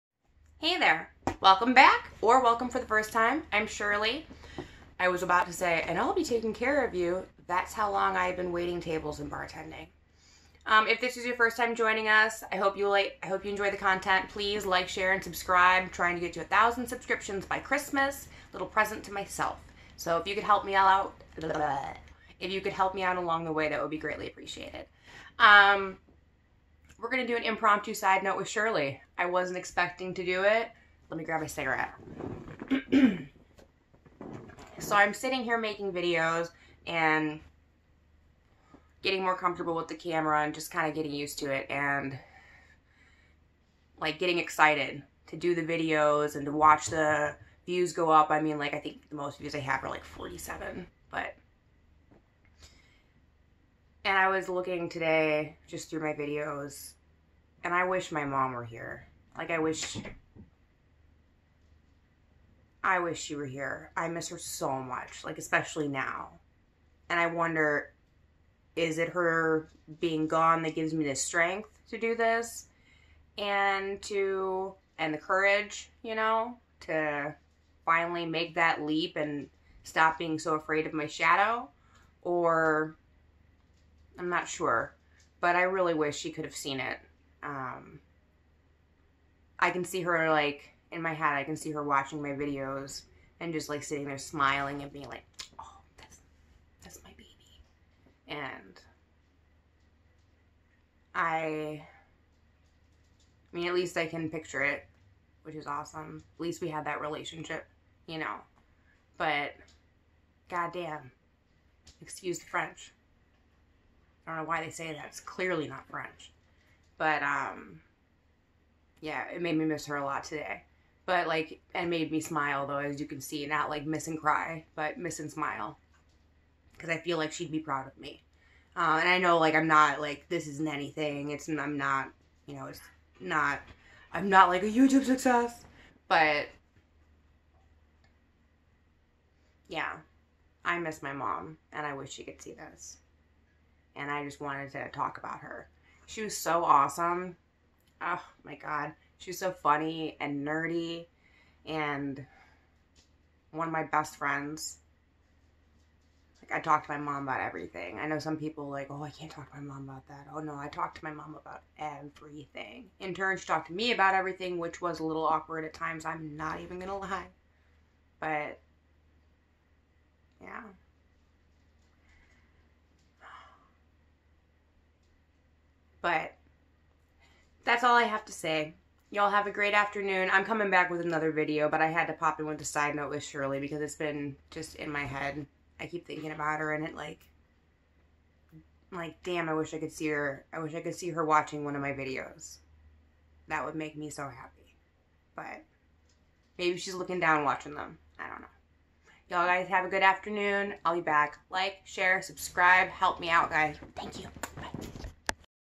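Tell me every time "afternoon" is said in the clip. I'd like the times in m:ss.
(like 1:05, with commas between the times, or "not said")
2:59, 3:20.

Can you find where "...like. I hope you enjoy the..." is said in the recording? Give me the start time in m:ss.
0:12.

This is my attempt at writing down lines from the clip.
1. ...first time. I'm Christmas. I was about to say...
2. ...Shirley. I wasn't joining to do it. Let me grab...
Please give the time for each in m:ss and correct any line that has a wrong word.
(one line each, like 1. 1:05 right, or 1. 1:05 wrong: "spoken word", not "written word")
1. 0:02 wrong: "Shirley", not "Christmas"
2. 0:28 wrong: "expecting", not "joining".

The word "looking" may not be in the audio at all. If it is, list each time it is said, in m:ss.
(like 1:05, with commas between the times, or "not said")
0:54, 3:16.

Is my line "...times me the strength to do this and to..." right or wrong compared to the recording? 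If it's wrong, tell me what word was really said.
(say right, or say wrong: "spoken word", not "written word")
wrong: "gives", not "times".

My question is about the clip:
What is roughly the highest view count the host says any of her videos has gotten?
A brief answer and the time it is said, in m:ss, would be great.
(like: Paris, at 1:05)
47, at 0:50.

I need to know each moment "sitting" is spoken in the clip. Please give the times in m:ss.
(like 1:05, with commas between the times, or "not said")
0:35, 1:33.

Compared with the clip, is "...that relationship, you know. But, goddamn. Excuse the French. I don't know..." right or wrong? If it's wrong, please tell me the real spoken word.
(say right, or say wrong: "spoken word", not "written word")
right.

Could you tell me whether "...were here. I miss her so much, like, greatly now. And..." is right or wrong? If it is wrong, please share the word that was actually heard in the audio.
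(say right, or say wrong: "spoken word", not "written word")
wrong: "especially", not "greatly".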